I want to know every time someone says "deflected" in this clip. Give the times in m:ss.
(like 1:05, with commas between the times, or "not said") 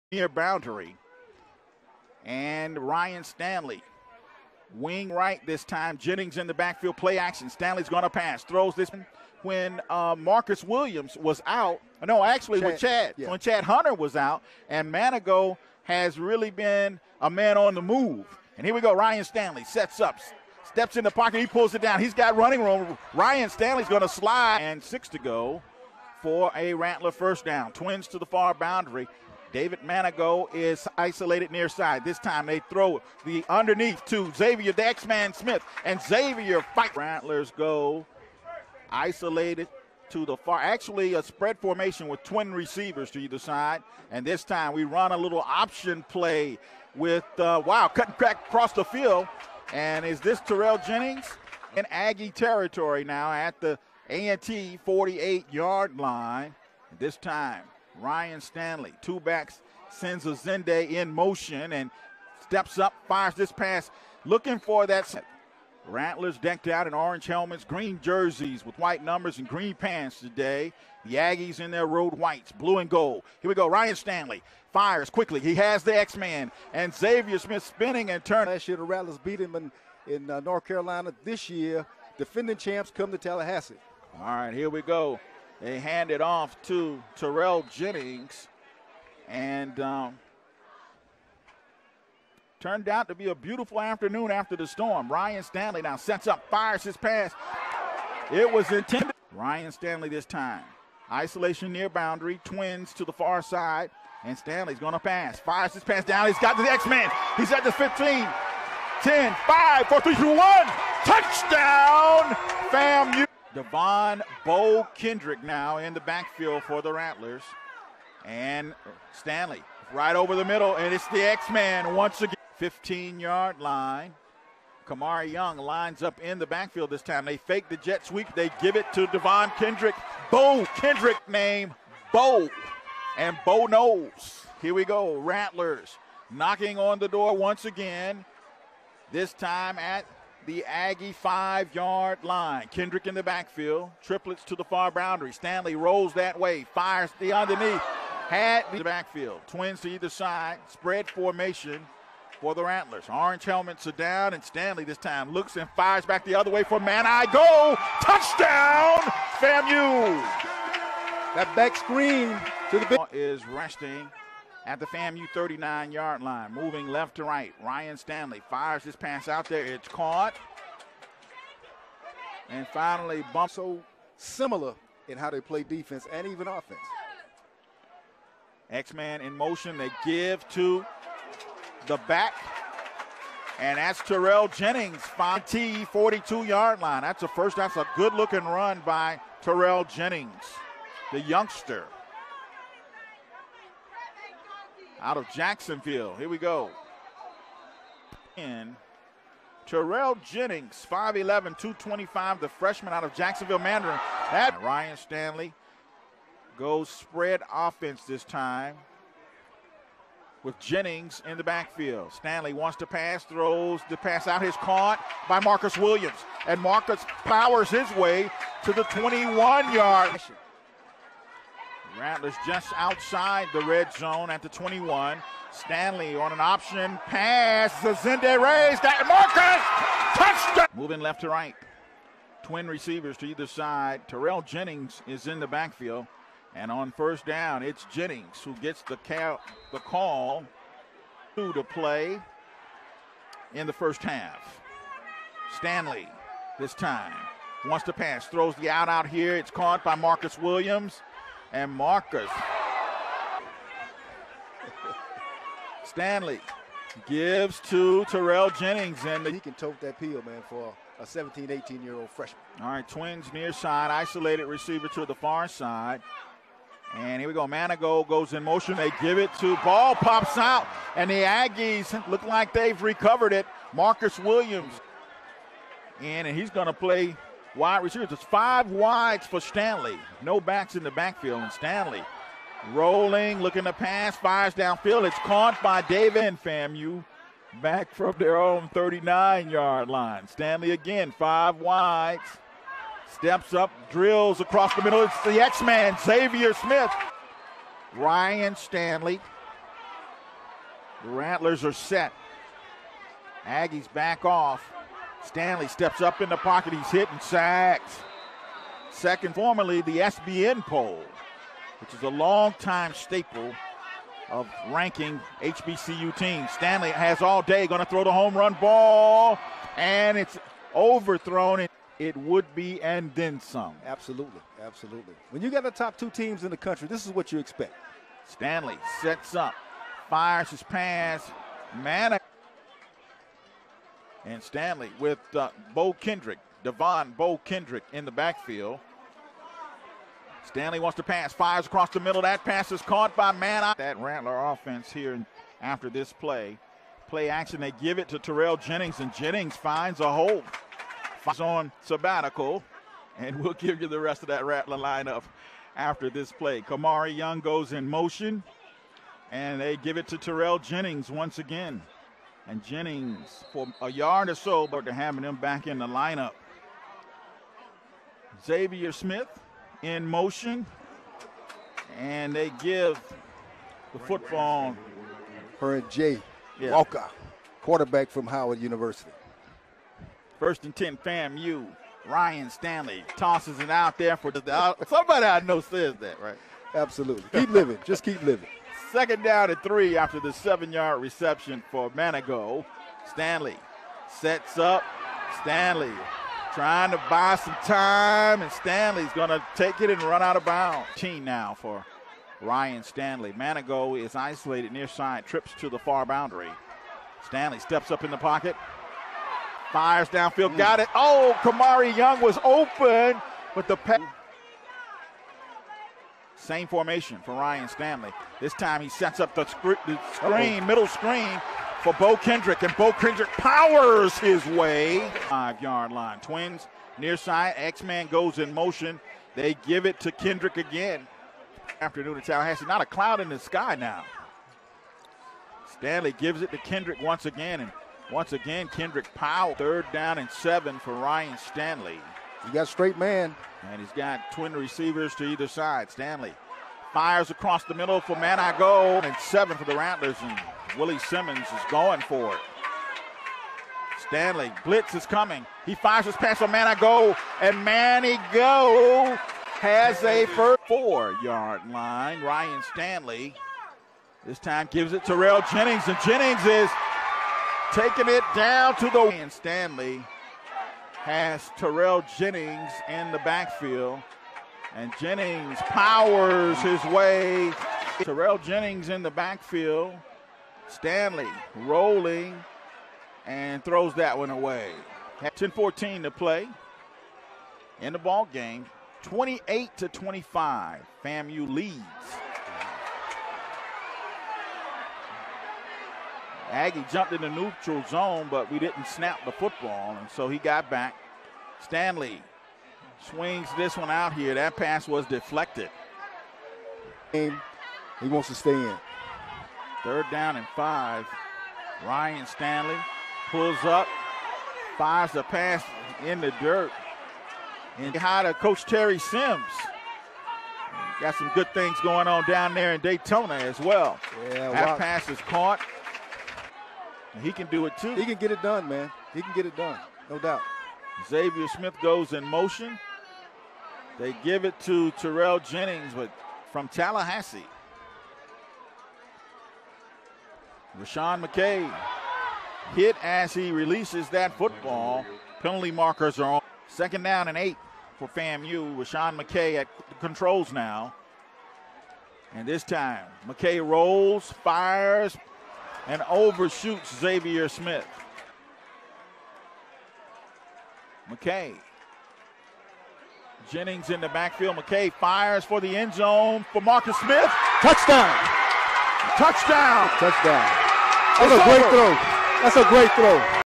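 8:25.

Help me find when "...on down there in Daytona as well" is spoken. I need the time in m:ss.
8:42.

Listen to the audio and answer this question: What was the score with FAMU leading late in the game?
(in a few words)
28 to 25.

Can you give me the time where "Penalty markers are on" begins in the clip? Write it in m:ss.
9:05.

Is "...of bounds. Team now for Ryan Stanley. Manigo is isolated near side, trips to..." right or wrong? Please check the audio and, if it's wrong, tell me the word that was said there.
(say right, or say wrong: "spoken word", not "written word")
right.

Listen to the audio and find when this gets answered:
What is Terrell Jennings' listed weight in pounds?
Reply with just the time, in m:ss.
3:21.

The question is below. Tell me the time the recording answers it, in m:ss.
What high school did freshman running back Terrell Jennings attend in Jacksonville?
3:23.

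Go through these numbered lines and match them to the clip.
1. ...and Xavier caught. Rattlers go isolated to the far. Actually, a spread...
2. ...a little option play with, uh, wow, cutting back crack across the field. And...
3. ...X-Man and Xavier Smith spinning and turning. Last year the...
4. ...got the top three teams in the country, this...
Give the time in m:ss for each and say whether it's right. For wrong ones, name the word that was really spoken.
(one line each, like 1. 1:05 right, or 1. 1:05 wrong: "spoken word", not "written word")
1. 0:35 wrong: "fight", not "caught"
2. 0:45 right
3. 1:15 right
4. 5:25 wrong: "two", not "three".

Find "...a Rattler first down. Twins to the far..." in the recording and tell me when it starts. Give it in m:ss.
0:26.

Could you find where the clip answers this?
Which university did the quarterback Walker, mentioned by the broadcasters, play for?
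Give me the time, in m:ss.
6:18.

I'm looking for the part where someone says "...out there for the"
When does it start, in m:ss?
6:23.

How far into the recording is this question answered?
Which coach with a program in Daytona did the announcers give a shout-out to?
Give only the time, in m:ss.
8:38.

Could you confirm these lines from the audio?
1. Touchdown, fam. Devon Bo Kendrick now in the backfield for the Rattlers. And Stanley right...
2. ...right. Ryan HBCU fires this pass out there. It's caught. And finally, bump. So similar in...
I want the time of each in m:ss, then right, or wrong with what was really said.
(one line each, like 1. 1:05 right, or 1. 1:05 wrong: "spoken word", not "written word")
1. 1:51 right
2. 2:47 wrong: "Stanley", not "HBCU".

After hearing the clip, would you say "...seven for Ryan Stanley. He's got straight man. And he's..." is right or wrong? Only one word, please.
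right.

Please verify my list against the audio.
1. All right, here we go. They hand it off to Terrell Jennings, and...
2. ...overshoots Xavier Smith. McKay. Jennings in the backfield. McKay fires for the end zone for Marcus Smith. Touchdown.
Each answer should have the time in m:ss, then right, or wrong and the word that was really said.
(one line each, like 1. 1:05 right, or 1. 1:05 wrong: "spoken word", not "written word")
1. 1:24 right
2. 9:16 right.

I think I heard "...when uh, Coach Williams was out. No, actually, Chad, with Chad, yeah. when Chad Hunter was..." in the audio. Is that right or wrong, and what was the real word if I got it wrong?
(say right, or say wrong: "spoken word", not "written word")
wrong: "Marcus", not "Coach".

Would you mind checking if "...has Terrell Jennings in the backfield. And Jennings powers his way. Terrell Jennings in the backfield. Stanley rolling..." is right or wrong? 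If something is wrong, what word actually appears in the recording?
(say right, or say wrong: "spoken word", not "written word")
right.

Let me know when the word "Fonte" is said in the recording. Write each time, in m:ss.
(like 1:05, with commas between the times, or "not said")
3:05.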